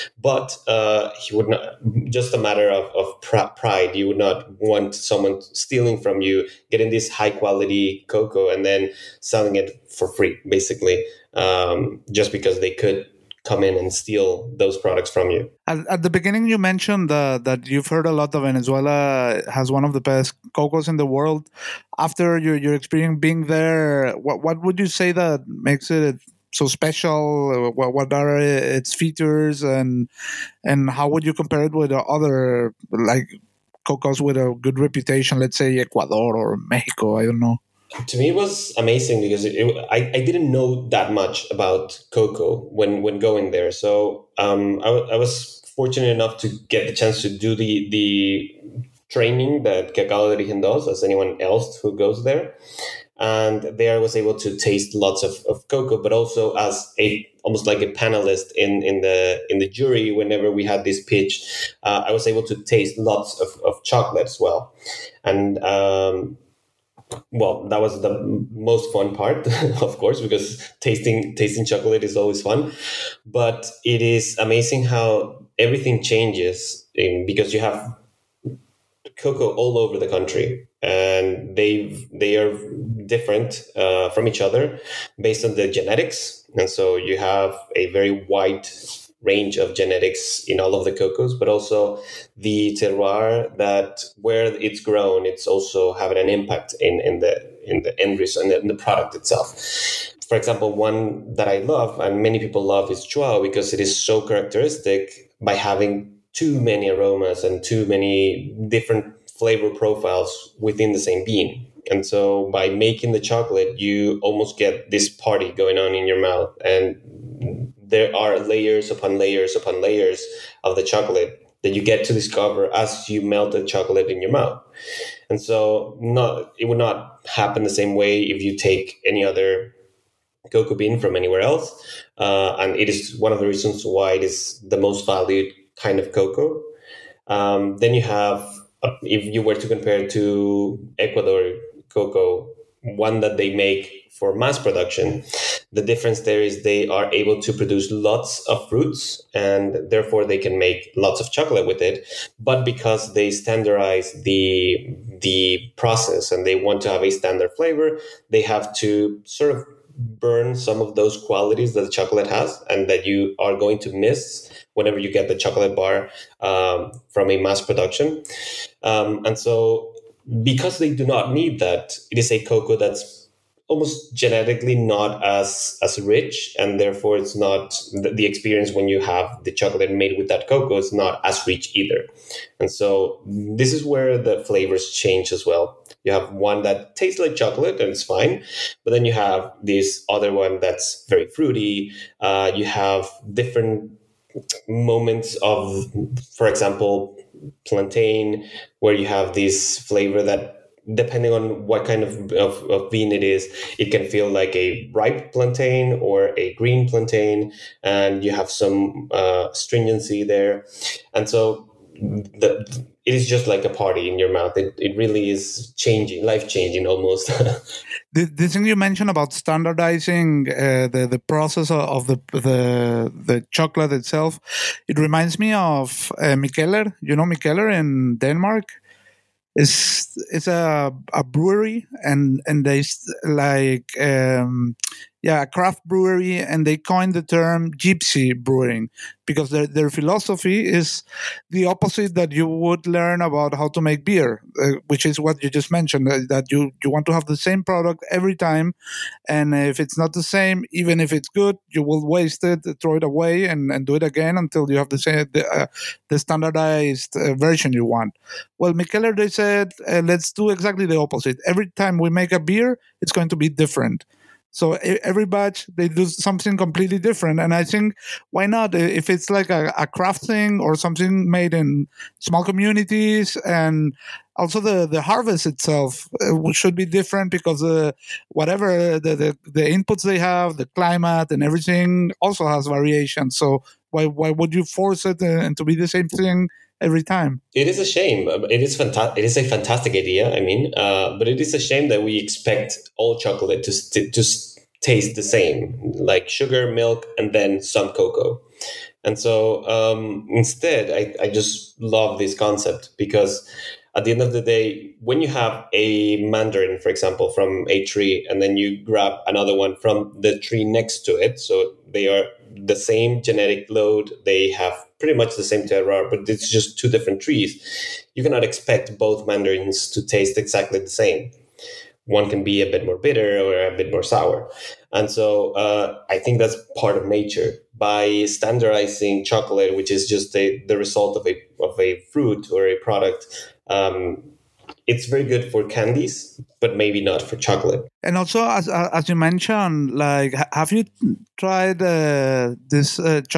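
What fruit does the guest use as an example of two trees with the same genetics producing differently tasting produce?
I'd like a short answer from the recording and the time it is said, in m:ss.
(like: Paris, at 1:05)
mandarin, at 5:06.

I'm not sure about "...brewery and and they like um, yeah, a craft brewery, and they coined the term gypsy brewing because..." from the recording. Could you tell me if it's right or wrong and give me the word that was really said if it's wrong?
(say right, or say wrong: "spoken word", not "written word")
right.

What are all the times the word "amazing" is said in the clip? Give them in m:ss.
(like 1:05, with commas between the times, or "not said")
0:38, 1:14.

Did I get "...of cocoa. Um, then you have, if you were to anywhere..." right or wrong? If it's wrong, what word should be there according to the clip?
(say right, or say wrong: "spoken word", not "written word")
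wrong: "compare", not "anywhere".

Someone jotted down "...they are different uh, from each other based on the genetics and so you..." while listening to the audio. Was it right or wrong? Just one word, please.
right.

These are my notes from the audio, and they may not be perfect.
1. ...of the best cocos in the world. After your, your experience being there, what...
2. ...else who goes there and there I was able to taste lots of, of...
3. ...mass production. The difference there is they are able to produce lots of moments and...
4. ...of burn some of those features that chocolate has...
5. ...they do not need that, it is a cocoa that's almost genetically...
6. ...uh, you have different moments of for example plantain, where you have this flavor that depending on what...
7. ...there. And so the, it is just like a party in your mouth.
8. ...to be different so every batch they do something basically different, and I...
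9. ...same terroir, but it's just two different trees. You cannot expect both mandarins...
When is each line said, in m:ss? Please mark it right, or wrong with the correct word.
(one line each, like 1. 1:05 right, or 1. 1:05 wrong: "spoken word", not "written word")
1. 0:19 right
2. 0:51 right
3. 2:24 wrong: "fruits", not "moments"
4. 2:39 wrong: "qualities", not "features"
5. 2:50 right
6. 3:12 right
7. 3:30 right
8. 4:23 wrong: "completely", not "basically"
9. 5:15 right.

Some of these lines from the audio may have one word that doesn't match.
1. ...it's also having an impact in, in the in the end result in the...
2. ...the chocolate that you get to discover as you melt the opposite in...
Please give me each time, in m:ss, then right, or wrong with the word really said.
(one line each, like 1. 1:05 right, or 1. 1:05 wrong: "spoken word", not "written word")
1. 1:35 right
2. 2:00 wrong: "chocolate", not "opposite".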